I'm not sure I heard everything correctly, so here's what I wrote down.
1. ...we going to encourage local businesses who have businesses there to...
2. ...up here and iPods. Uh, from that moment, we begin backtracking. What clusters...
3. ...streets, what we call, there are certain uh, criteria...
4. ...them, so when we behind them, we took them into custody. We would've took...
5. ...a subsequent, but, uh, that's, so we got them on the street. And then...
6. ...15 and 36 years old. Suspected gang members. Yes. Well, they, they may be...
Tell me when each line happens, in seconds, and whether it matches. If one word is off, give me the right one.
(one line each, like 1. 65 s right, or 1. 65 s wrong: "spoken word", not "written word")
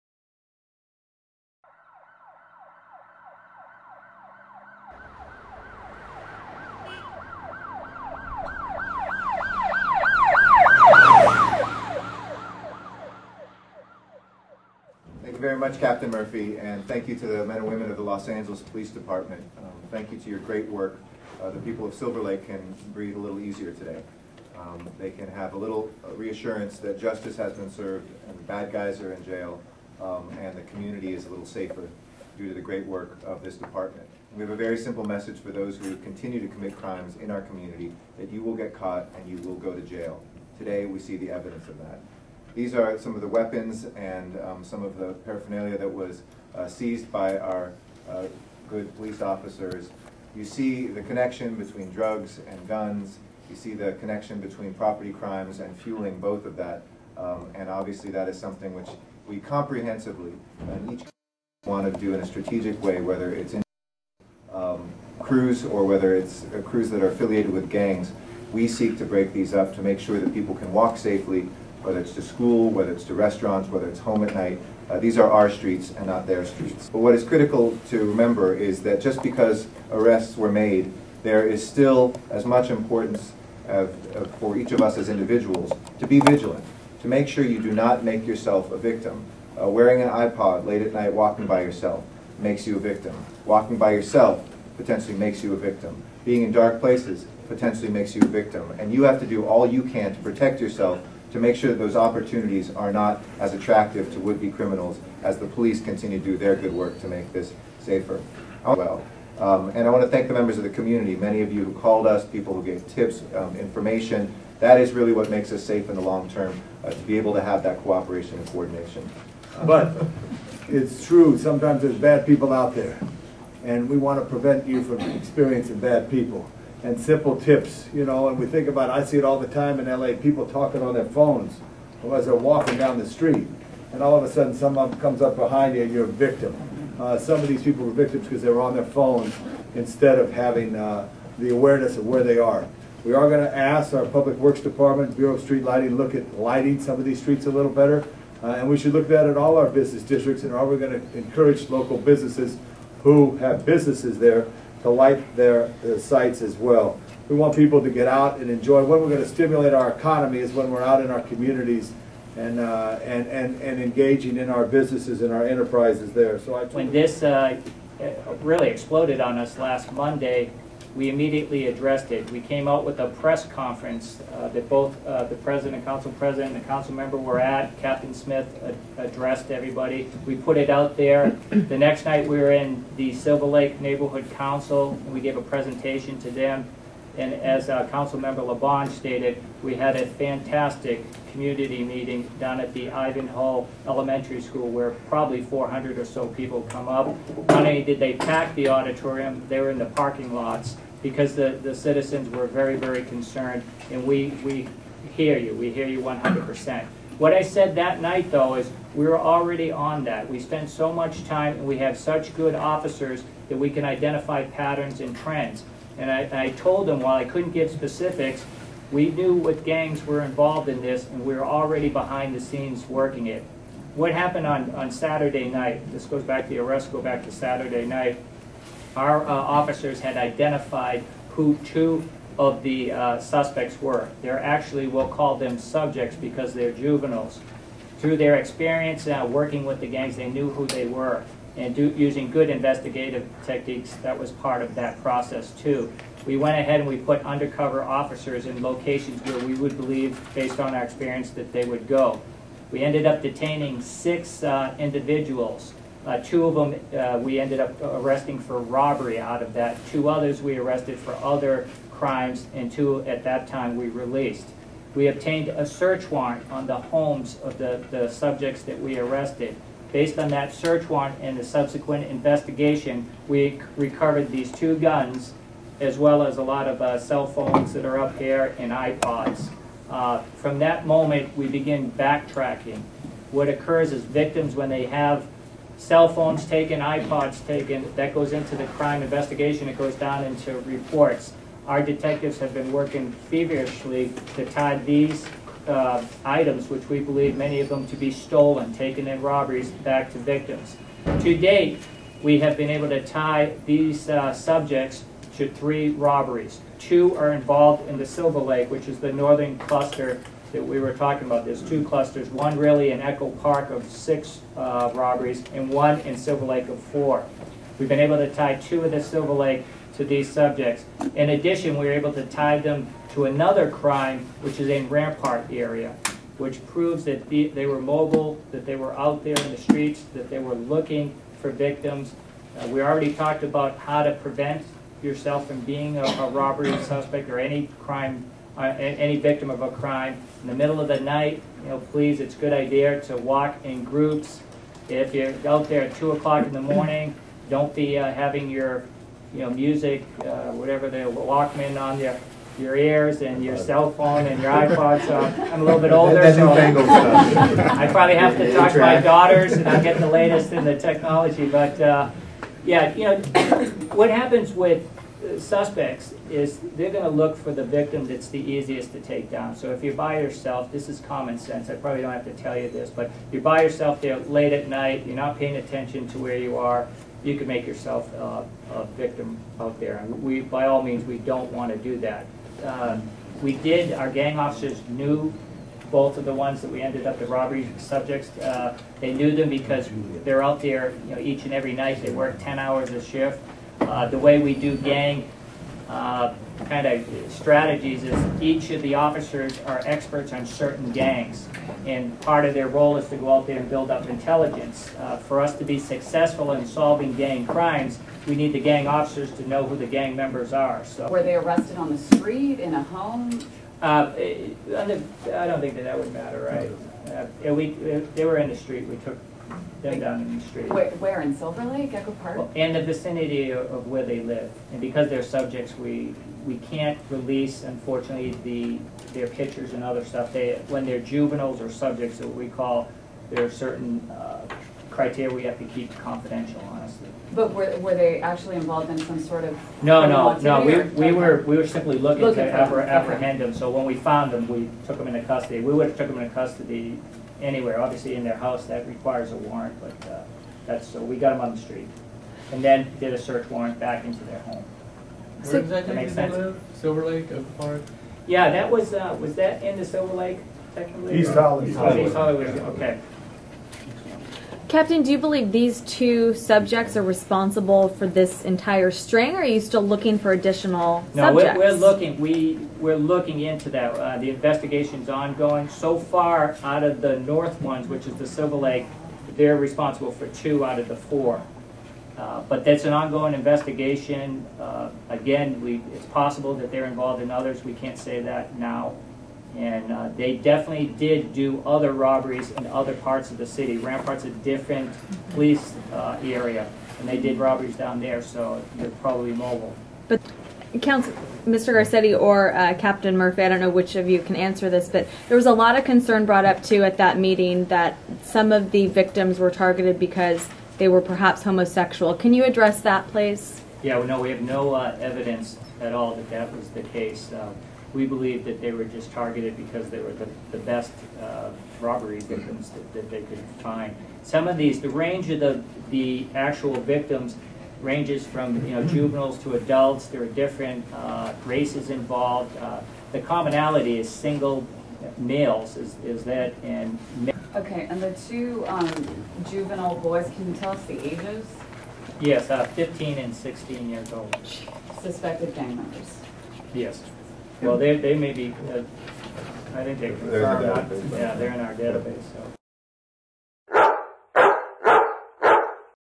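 1. 150 s right
2. 277 s wrong: "occurs", not "clusters"
3. 431 s wrong: "subjects", not "streets"
4. 443 s wrong: "found", not "behind"
5. 449 s wrong: "warrant", not "subsequent"
6. 542 s wrong: "16", not "36".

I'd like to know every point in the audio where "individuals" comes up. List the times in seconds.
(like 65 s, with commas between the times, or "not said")
85 s, 254 s.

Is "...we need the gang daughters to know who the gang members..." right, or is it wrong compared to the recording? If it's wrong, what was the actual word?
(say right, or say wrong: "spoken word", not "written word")
wrong: "officers", not "daughters".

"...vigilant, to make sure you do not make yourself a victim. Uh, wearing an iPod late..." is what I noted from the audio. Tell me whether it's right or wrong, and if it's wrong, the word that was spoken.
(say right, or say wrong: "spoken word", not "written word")
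right.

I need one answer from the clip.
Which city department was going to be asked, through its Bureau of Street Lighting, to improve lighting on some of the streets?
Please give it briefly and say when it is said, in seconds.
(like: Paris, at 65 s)
Public Works Department, at 144 s.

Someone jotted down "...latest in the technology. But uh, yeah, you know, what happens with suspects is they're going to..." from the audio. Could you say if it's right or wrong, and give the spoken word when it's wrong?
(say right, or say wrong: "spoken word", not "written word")
right.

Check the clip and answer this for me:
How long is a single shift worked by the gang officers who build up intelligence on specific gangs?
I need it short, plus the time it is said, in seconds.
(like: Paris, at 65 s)
10 hours, at 392 s.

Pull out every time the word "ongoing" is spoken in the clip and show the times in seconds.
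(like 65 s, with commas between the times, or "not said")
475 s, 482 s.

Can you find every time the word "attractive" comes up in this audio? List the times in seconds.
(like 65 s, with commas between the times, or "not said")
103 s.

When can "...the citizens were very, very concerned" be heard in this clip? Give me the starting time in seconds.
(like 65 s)
201 s.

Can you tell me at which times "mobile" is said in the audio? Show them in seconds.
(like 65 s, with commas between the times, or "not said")
327 s, 499 s.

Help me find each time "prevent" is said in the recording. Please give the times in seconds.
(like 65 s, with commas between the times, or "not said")
124 s, 334 s.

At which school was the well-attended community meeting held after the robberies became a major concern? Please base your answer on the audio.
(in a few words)
Ivanhoe Elementary School.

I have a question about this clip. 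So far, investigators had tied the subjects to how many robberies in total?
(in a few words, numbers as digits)
3.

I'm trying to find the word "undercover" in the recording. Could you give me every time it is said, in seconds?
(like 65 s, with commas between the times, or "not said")
247 s.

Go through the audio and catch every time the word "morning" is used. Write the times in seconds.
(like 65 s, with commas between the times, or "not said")
346 s.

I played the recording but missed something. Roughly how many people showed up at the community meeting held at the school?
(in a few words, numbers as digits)
400.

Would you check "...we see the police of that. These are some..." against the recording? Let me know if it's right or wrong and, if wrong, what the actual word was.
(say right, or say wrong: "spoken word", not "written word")
wrong: "evidence", not "police".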